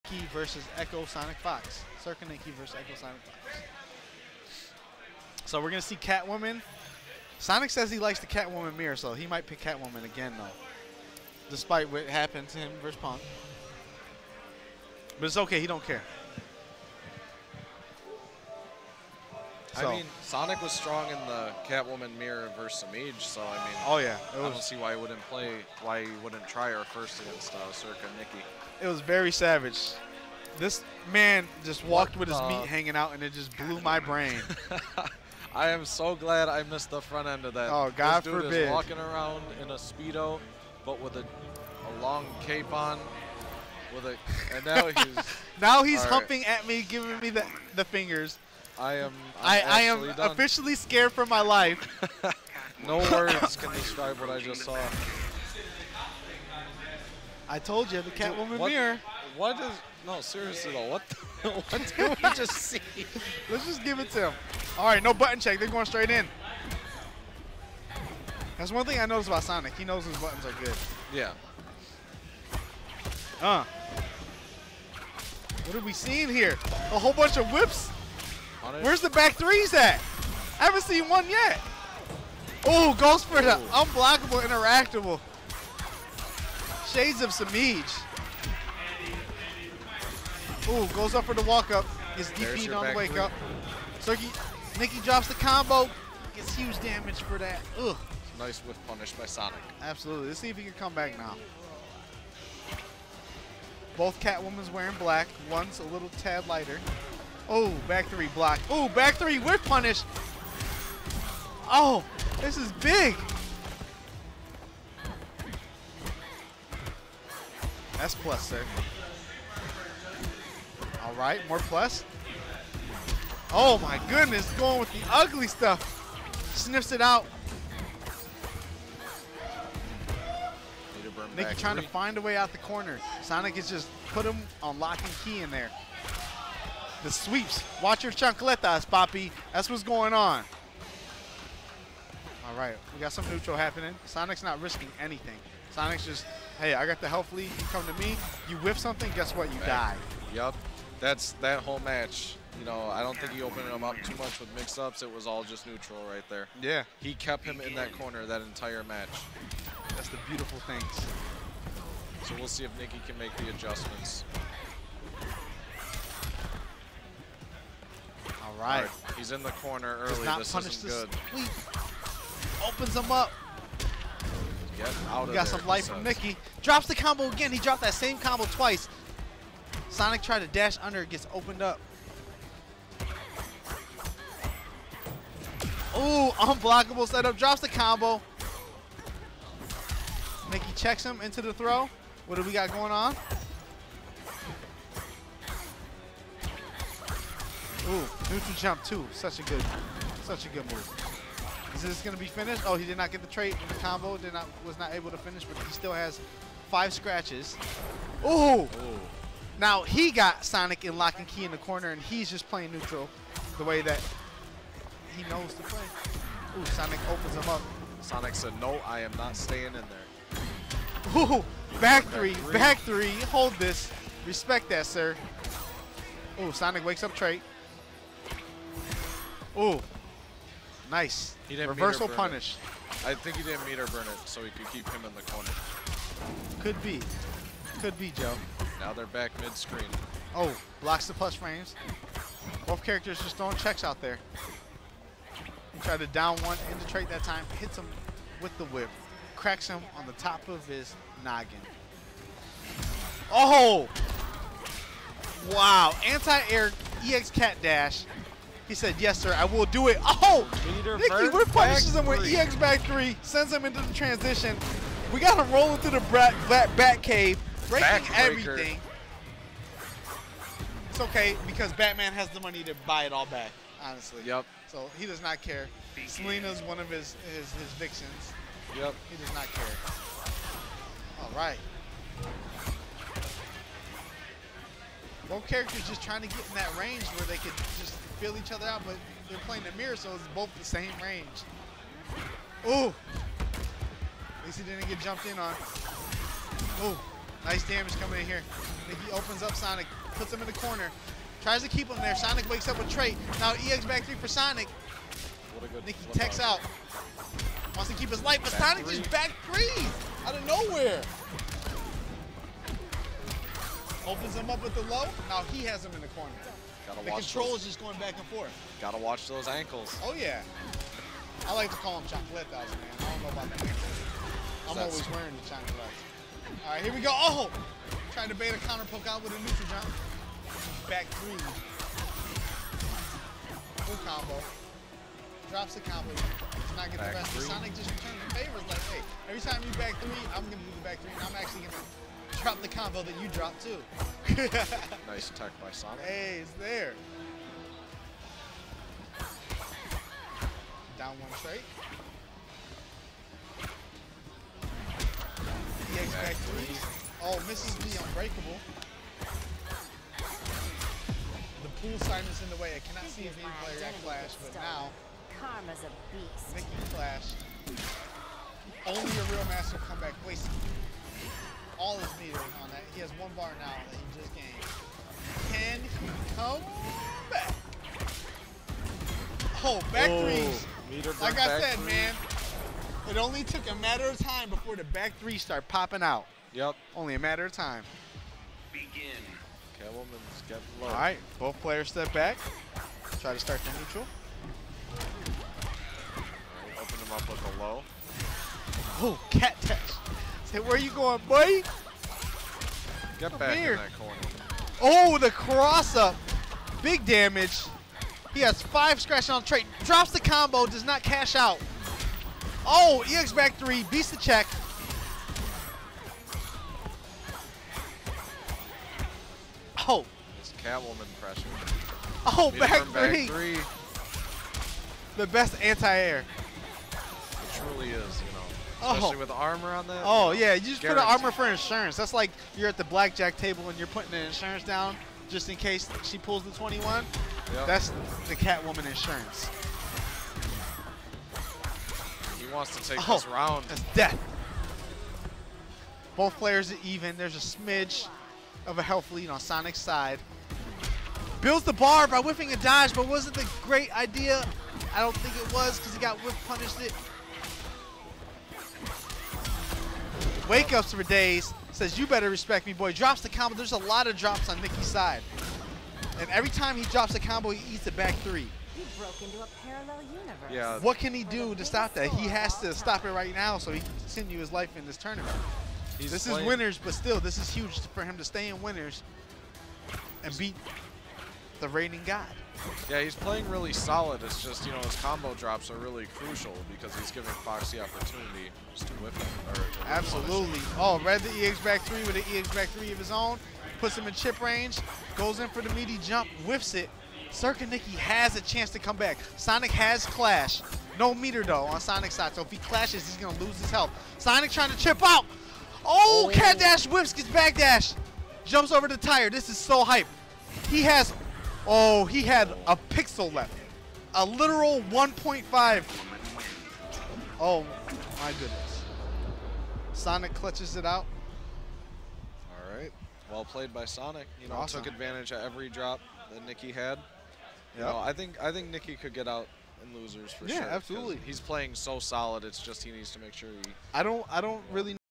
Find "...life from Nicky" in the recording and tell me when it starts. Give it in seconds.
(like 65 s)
175 s.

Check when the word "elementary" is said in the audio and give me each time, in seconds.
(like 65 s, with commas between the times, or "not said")
not said.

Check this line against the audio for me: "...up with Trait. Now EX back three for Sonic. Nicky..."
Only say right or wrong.
right.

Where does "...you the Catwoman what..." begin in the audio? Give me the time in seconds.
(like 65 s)
57 s.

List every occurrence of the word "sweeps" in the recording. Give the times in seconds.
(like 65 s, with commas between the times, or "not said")
137 s, 171 s.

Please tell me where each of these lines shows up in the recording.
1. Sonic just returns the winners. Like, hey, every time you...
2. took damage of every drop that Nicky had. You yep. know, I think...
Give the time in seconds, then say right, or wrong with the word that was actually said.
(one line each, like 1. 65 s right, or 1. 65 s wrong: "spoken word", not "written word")
1. 337 s wrong: "favors", not "winners"
2. 524 s wrong: "advantage", not "damage".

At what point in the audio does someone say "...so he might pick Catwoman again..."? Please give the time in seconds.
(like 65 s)
8 s.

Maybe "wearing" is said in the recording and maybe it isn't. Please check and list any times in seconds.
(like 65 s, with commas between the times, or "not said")
104 s, 325 s.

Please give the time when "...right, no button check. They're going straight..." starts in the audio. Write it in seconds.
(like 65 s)
64 s.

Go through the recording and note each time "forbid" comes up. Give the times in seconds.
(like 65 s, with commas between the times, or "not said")
38 s.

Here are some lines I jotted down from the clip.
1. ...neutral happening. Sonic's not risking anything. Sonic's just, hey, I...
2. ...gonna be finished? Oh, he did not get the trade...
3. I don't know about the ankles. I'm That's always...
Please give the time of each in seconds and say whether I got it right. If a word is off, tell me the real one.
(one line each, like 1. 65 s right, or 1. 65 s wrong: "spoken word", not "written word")
1. 143 s right
2. 202 s right
3. 322 s right.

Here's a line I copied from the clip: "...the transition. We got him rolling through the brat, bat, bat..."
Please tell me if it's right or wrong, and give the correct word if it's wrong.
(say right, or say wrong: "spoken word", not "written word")
right.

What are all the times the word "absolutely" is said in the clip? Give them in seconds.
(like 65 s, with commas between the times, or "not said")
99 s, 489 s, 530 s.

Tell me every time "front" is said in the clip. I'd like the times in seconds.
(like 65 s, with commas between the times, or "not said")
37 s.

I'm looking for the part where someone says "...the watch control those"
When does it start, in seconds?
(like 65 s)
316 s.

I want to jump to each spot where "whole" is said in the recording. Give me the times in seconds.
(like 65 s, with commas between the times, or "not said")
76 s, 151 s.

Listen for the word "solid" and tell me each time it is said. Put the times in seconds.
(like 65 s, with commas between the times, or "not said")
483 s, 531 s.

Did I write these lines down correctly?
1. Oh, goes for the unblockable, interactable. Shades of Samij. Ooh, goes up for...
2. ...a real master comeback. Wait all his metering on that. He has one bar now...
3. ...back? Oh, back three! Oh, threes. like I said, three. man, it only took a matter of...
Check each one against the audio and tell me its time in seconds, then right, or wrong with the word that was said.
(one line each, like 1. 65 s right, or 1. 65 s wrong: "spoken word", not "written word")
1. 82 s right
2. 369 s right
3. 377 s right.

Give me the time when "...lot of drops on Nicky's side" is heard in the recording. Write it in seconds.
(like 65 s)
463 s.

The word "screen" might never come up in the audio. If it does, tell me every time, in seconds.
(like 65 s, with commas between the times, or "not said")
239 s.